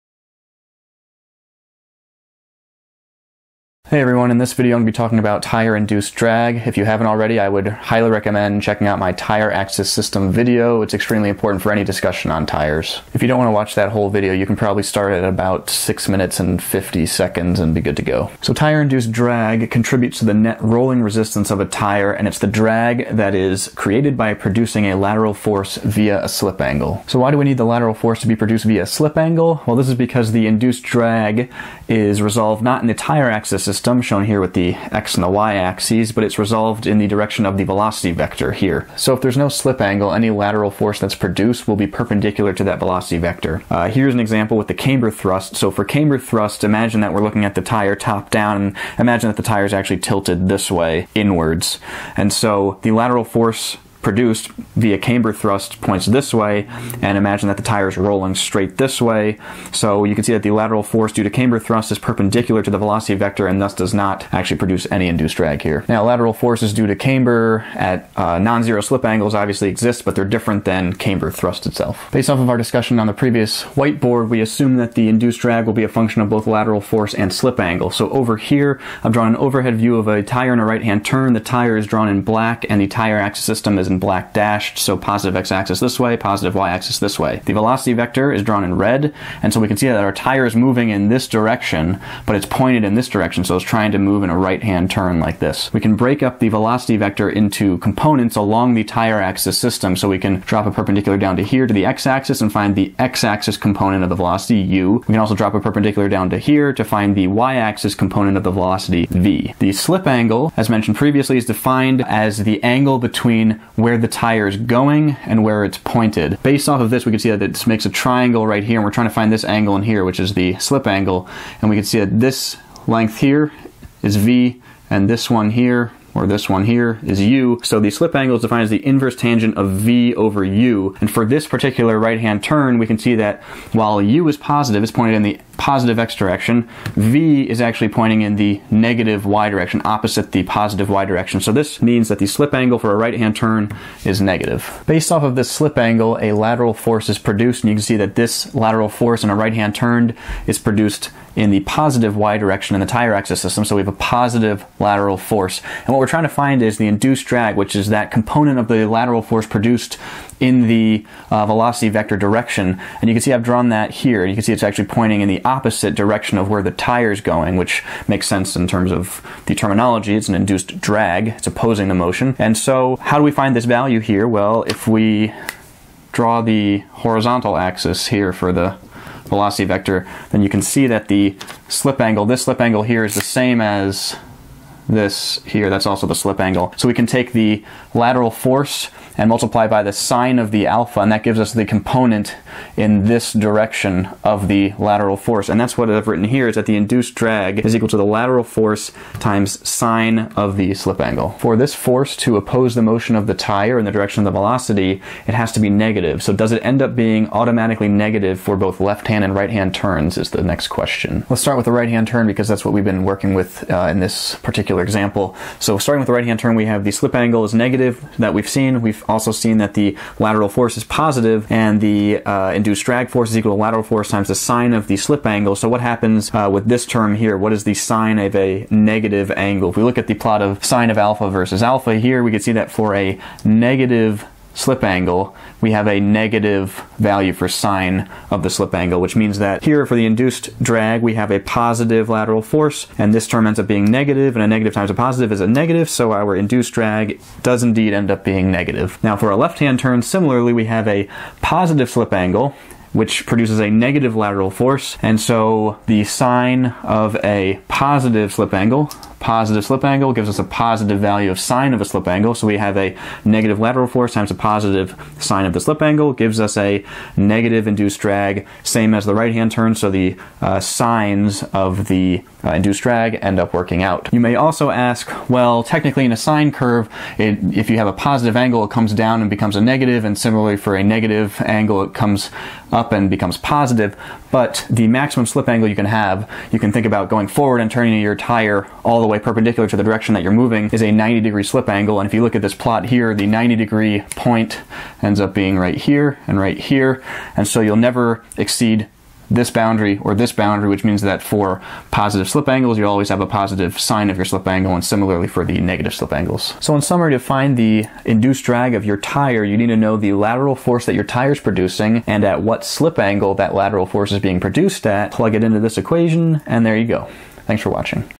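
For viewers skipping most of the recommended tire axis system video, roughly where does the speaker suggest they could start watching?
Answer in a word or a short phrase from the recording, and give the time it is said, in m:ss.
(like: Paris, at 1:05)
6 minutes 50 seconds, at 0:15.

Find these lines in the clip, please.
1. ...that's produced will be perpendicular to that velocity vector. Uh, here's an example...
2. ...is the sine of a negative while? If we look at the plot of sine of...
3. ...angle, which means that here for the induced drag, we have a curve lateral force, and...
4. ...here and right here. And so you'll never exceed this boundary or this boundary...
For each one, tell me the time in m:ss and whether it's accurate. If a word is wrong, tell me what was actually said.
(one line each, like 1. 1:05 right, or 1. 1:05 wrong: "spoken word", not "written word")
1. 0:40 right
2. 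3:47 wrong: "angle", not "while"
3. 3:58 wrong: "positive", not "curve"
4. 4:55 right.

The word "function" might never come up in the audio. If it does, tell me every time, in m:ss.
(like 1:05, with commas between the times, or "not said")
1:15.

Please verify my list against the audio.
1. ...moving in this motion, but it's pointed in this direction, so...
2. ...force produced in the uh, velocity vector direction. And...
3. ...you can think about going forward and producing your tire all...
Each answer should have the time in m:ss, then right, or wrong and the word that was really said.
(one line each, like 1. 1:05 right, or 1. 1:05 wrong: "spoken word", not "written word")
1. 1:30 wrong: "direction", not "motion"
2. 2:39 right
3. 4:46 wrong: "turning", not "producing".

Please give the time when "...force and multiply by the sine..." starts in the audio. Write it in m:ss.
3:08.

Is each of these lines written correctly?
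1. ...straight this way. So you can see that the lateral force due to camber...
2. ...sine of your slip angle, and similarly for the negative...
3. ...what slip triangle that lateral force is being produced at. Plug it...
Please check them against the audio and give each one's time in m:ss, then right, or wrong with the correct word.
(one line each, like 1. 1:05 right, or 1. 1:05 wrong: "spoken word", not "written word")
1. 0:58 right
2. 5:03 right
3. 5:12 wrong: "angle", not "triangle".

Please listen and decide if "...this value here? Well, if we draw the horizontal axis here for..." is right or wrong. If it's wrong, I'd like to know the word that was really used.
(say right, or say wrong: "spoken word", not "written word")
right.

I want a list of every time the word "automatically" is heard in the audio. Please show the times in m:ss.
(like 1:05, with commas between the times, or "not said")
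3:27.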